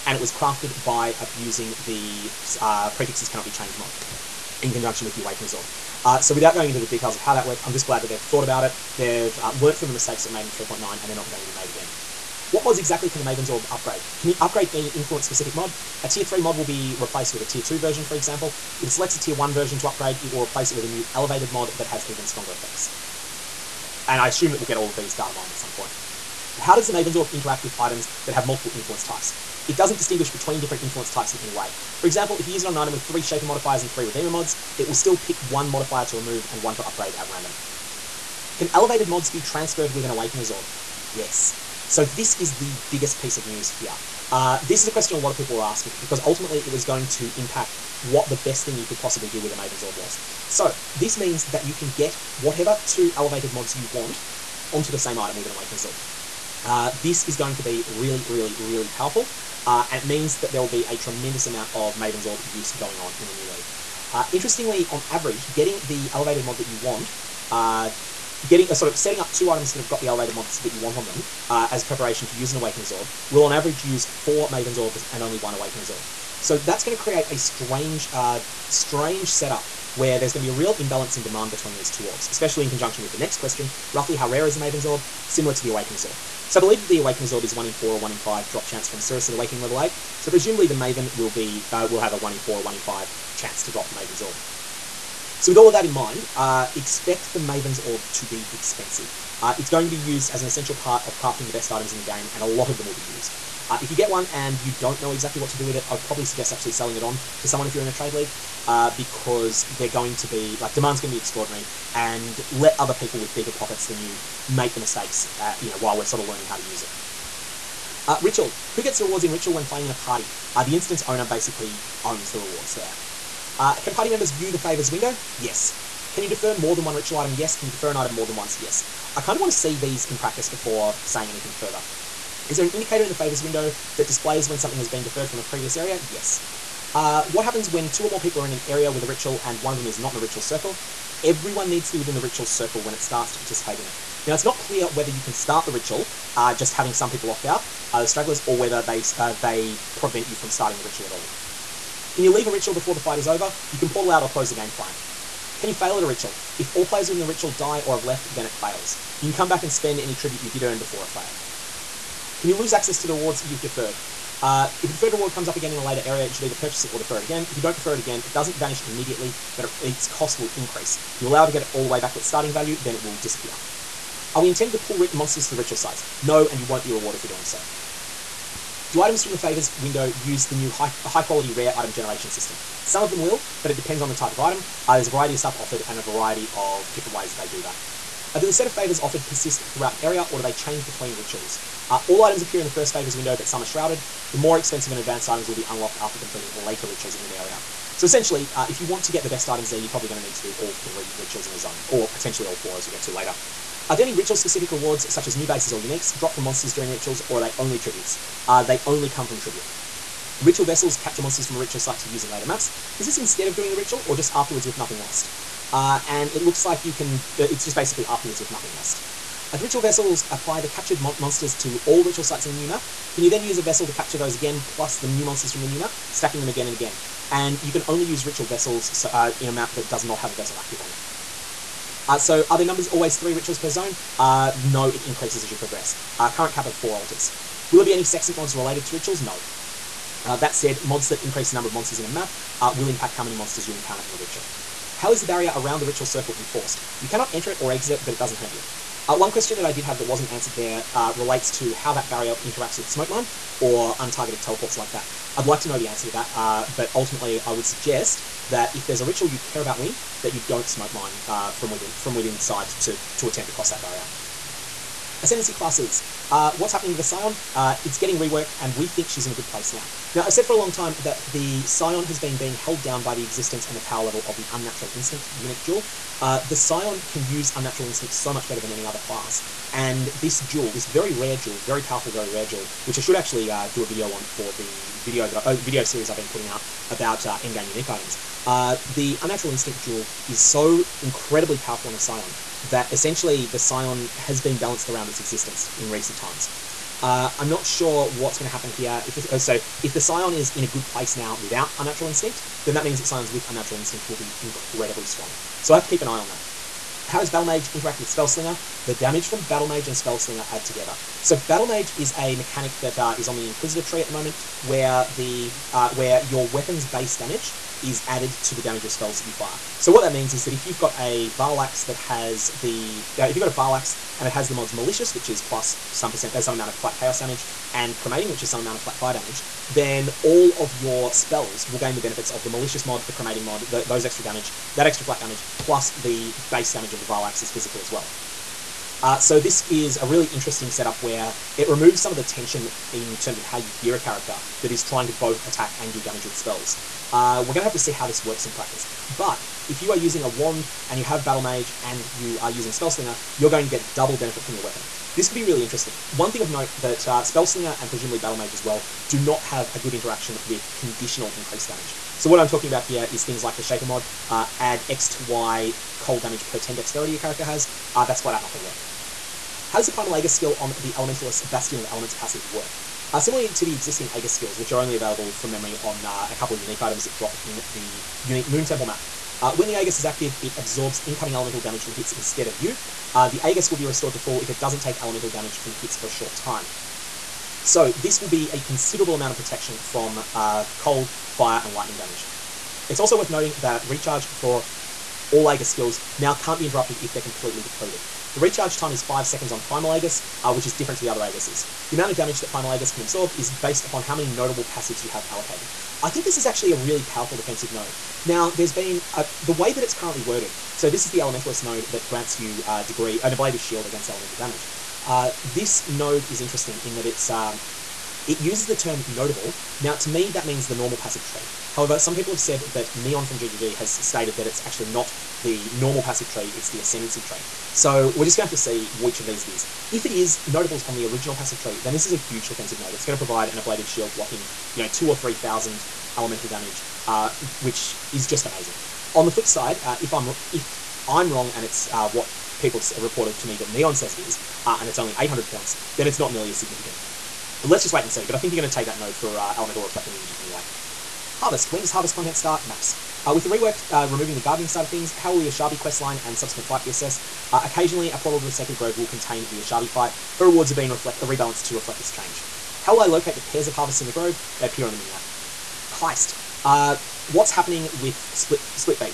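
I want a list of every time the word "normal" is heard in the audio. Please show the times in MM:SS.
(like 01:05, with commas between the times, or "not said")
07:00, 07:05.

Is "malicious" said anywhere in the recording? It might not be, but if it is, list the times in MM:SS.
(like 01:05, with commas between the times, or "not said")
05:24, 05:32.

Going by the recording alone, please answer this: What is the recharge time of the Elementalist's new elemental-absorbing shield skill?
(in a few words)
5 seconds.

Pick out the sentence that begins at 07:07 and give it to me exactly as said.
So we're just going to have to see which of these it is.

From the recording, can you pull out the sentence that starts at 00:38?
Can elevated mods be transferred with an Awakener's Orb?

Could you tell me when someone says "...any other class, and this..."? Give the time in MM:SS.
04:38.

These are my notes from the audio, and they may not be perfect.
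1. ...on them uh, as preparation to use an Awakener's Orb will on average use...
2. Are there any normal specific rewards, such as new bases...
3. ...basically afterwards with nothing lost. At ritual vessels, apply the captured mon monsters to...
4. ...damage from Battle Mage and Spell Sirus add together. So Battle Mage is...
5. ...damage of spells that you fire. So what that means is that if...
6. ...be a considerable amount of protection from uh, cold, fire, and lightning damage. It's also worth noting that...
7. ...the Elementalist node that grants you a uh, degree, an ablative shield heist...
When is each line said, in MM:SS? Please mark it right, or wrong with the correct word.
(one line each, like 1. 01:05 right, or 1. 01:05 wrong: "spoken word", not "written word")
1. 01:10 right
2. 03:23 wrong: "ritual", not "normal"
3. 03:37 right
4. 05:08 wrong: "Slinger", not "Sirus"
5. 05:18 right
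6. 06:28 right
7. 06:51 wrong: "against", not "heist".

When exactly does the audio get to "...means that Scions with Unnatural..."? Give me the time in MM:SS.
05:02.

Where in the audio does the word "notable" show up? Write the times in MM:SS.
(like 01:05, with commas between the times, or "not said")
06:44, 06:59, 07:10.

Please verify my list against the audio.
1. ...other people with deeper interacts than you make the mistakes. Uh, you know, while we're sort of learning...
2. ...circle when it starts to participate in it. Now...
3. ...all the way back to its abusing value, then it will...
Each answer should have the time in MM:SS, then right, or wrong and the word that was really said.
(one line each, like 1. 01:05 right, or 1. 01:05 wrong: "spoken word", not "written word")
1. 01:52 wrong: "pockets", not "interacts"
2. 02:22 right
3. 02:51 wrong: "starting", not "abusing".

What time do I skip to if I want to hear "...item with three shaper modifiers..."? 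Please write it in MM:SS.
00:32.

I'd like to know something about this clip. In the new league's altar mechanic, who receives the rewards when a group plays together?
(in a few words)
The instance owner.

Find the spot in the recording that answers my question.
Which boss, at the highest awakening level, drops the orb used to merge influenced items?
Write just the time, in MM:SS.
01:28.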